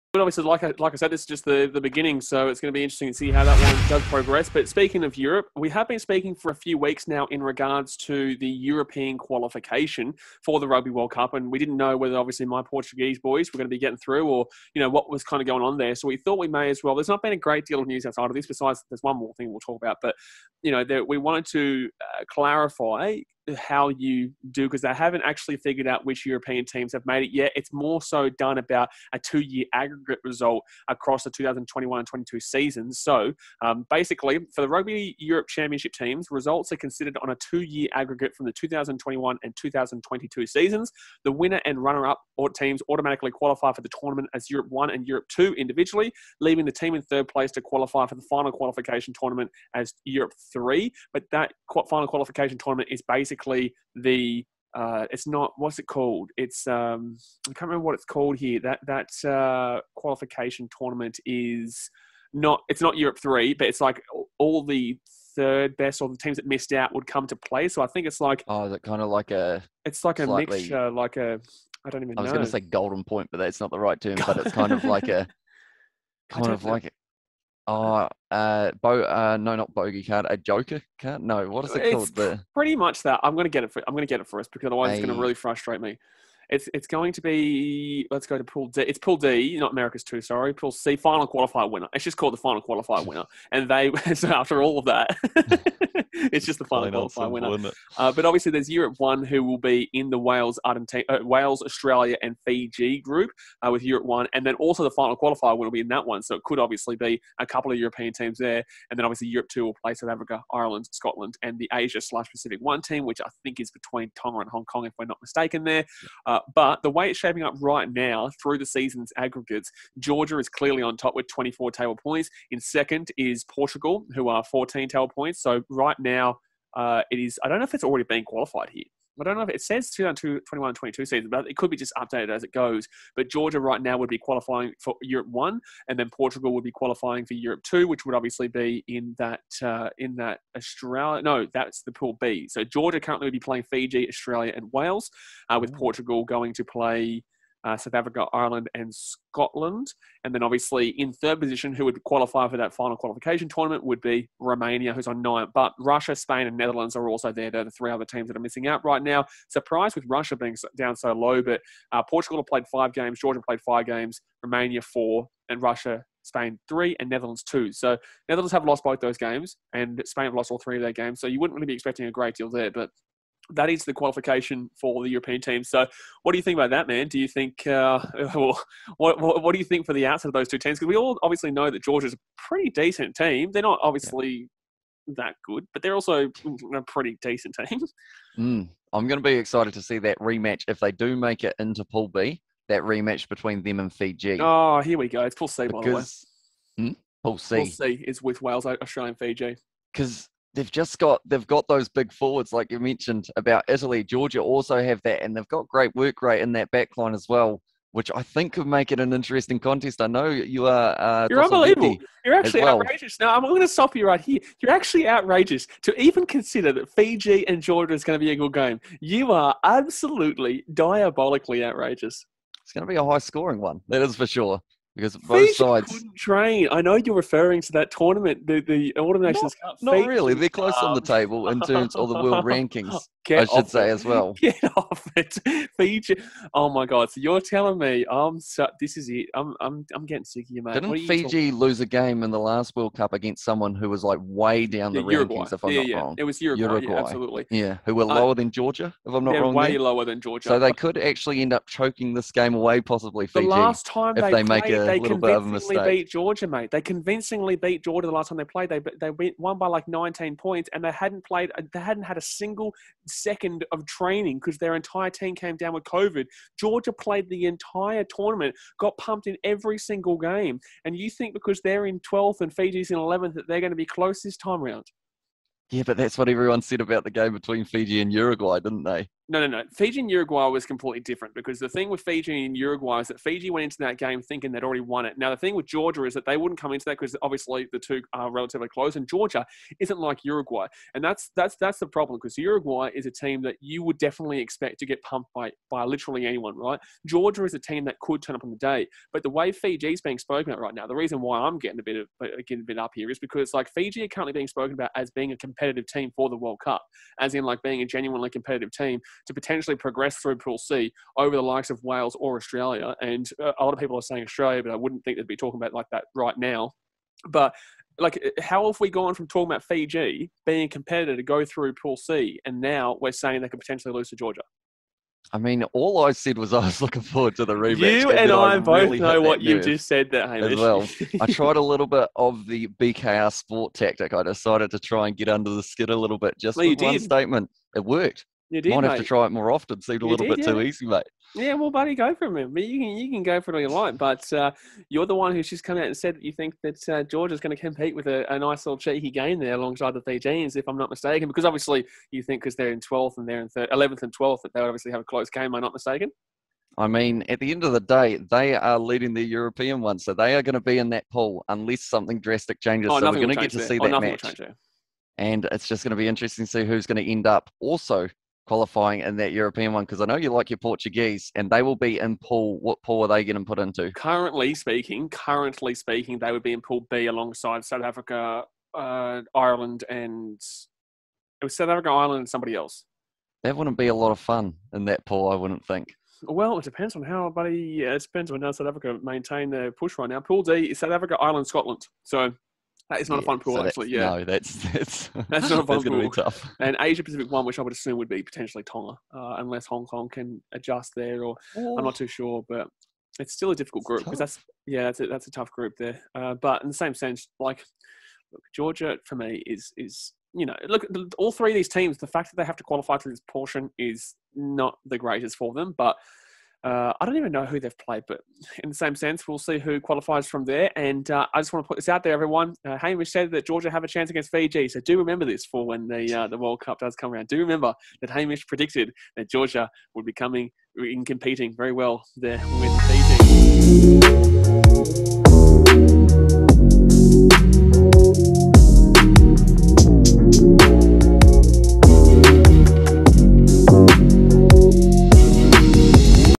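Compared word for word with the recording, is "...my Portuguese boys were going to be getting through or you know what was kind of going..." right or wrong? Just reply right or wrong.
right.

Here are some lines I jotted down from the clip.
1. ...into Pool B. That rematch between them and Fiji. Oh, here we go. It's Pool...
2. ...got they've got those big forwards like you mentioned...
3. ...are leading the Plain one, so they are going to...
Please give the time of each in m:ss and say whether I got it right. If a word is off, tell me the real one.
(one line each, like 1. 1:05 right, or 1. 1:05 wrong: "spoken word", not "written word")
1. 3:11 right
2. 3:20 right
3. 5:58 wrong: "European", not "Plain".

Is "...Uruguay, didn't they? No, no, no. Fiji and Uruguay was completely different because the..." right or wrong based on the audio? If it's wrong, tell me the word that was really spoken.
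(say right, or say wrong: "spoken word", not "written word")
right.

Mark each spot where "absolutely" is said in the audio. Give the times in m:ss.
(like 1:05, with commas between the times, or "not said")
3:39, 4:06.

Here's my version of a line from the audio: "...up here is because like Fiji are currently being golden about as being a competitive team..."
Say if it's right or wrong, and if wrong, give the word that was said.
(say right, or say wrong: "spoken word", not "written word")
wrong: "spoken", not "golden".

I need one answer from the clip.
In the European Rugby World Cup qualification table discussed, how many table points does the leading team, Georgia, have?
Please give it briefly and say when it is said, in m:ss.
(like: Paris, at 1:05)
24, at 2:01.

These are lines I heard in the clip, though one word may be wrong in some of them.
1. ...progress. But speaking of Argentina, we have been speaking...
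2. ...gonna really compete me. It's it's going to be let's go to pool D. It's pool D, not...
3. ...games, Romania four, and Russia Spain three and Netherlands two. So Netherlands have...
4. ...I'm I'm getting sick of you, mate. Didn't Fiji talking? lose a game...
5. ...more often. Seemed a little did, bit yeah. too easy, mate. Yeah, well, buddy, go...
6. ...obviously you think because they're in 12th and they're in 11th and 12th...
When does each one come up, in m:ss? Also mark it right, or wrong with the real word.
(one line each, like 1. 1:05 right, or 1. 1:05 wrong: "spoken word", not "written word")
1. 0:04 wrong: "Europe", not "Argentina"
2. 1:25 wrong: "frustrate", not "compete"
3. 2:43 right
4. 3:59 right
5. 5:39 right
6. 5:51 right.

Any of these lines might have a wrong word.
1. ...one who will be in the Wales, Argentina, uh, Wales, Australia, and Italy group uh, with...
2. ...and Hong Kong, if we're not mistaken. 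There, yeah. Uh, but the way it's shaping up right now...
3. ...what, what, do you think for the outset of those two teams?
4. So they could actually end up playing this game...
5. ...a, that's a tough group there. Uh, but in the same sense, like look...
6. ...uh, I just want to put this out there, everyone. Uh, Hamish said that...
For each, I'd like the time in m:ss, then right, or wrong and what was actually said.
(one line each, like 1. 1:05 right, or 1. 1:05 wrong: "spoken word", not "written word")
1. 1:38 wrong: "Fiji", not "Italy"
2. 1:54 right
3. 2:59 right
4. 4:10 wrong: "choking", not "playing"
5. 6:44 right
6. 7:01 right.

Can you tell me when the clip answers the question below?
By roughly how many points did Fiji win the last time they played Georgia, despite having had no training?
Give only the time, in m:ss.
4:19.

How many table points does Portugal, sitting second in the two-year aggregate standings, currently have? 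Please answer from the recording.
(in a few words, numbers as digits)
14.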